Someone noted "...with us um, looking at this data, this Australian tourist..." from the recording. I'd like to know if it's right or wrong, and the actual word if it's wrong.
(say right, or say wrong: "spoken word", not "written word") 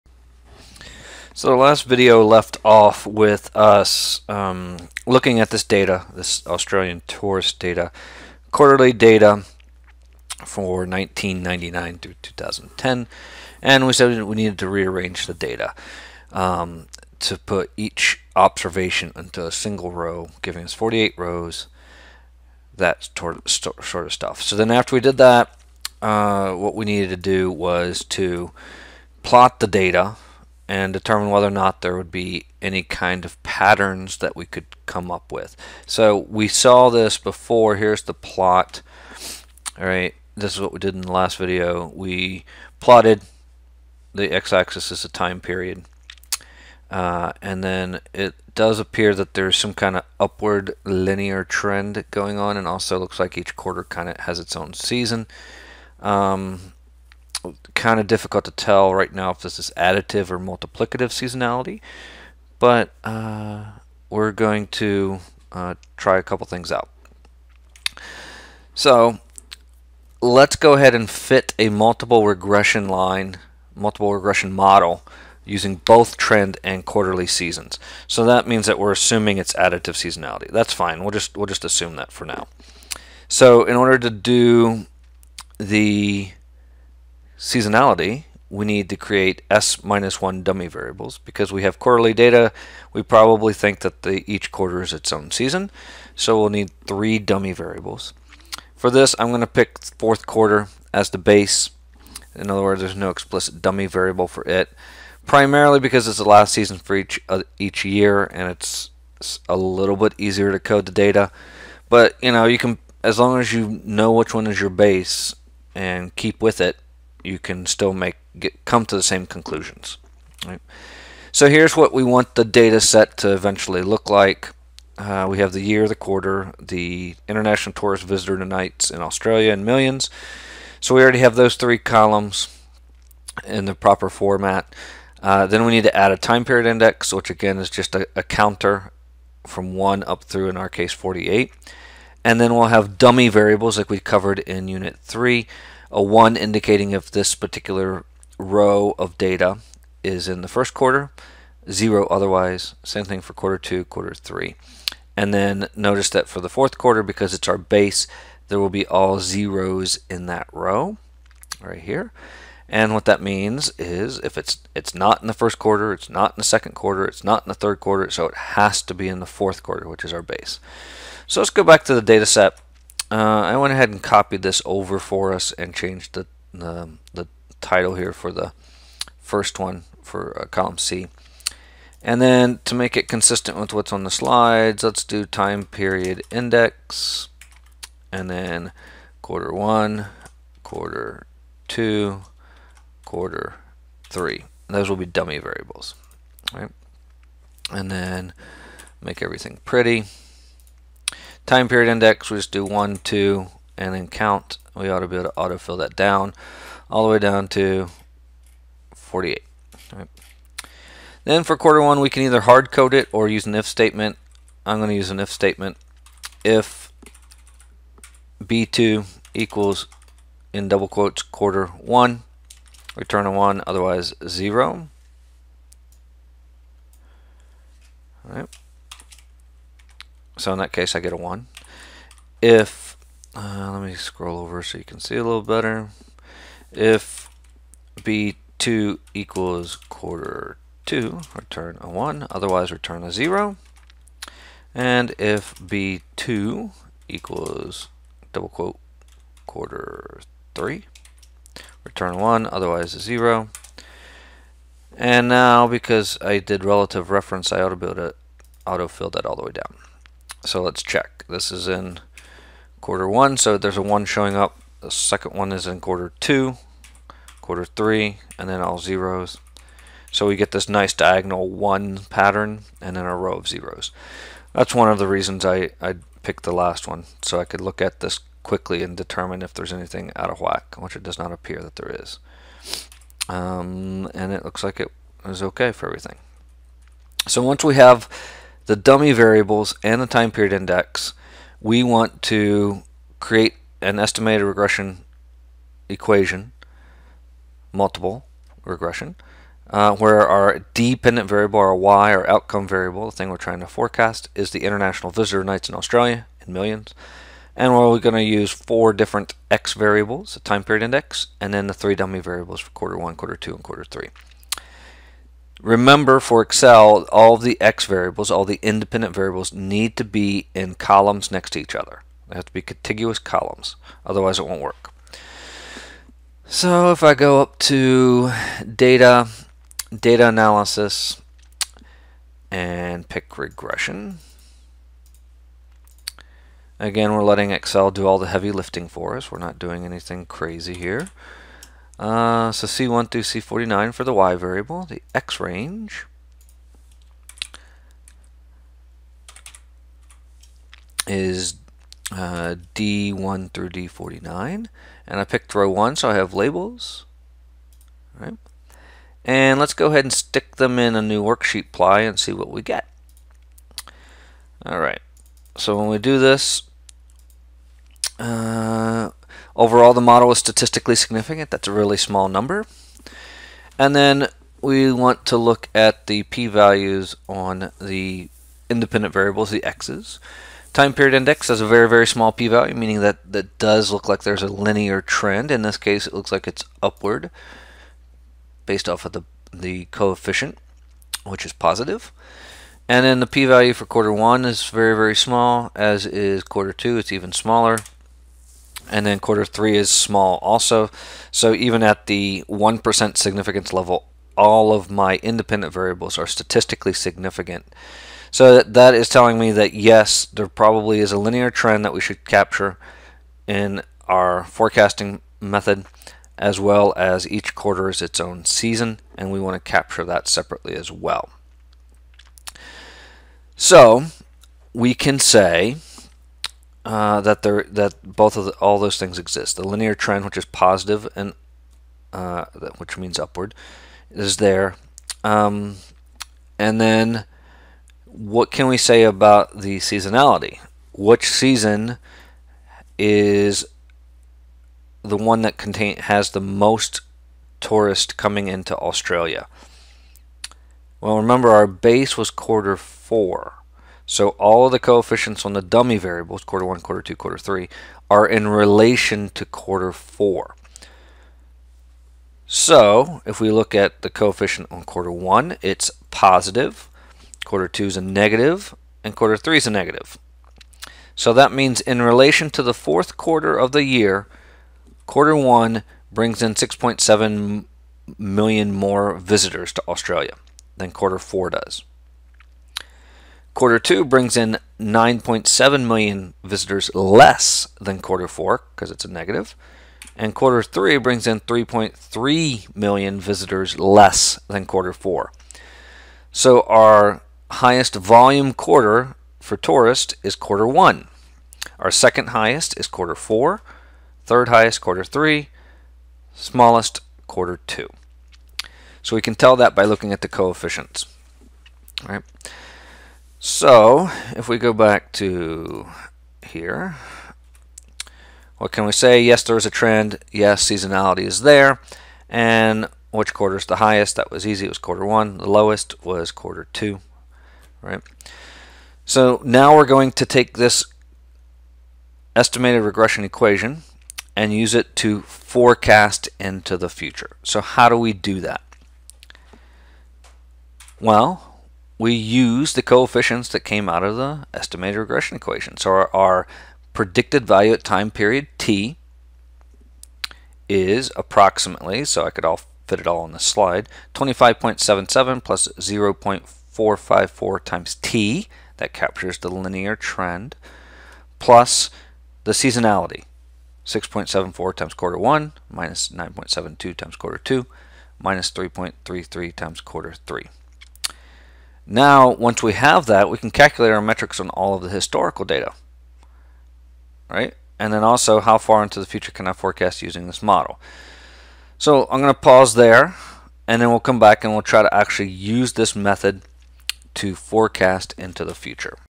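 right.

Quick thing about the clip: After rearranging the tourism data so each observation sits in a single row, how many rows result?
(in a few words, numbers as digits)
48.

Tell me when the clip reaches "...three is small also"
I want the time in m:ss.
6:39.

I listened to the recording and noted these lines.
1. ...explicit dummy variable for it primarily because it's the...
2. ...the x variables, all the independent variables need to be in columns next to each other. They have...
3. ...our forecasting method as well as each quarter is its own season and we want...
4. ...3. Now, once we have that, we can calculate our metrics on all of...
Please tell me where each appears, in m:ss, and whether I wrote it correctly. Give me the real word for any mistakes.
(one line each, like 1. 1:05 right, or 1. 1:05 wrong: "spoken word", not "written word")
1. 1:43 right
2. 5:17 right
3. 6:54 right
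4. 9:30 right.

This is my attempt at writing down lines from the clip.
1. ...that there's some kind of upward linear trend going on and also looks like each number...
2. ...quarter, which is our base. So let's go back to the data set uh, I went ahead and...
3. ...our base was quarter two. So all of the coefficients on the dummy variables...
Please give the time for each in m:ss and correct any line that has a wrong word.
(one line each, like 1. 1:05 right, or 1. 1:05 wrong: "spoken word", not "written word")
1. 0:49 wrong: "quarter", not "number"
2. 2:49 right
3. 7:31 wrong: "four", not "two".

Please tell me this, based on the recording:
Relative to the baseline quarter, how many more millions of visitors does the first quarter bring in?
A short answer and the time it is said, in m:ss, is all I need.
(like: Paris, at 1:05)
6.7 million, at 7:56.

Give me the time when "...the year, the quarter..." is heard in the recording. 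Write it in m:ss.
2:05.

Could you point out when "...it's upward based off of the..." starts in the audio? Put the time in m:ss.
6:26.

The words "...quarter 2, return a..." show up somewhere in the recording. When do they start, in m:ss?
3:59.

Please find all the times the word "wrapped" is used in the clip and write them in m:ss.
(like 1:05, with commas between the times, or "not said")
not said.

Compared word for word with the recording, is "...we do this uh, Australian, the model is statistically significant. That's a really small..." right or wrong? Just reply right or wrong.
wrong.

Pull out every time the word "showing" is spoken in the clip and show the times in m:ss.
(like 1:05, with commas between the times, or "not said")
4:24.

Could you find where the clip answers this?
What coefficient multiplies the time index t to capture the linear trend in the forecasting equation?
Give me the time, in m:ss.
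9:15.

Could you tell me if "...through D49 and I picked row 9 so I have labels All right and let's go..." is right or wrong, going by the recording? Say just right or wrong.
wrong.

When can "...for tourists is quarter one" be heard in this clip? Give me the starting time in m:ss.
8:19.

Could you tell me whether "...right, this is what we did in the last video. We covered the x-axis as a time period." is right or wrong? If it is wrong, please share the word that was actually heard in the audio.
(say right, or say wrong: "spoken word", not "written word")
wrong: "plotted", not "covered".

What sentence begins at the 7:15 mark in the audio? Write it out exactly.
Um, and then, what can we say about the seasonality?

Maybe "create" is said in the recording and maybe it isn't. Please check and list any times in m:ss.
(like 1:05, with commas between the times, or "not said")
1:28, 4:53.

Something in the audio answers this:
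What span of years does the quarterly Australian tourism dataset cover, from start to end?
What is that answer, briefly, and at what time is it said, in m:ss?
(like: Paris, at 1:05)
1999 through 2010, at 0:10.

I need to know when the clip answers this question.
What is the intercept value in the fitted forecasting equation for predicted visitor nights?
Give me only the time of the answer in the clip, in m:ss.
9:14.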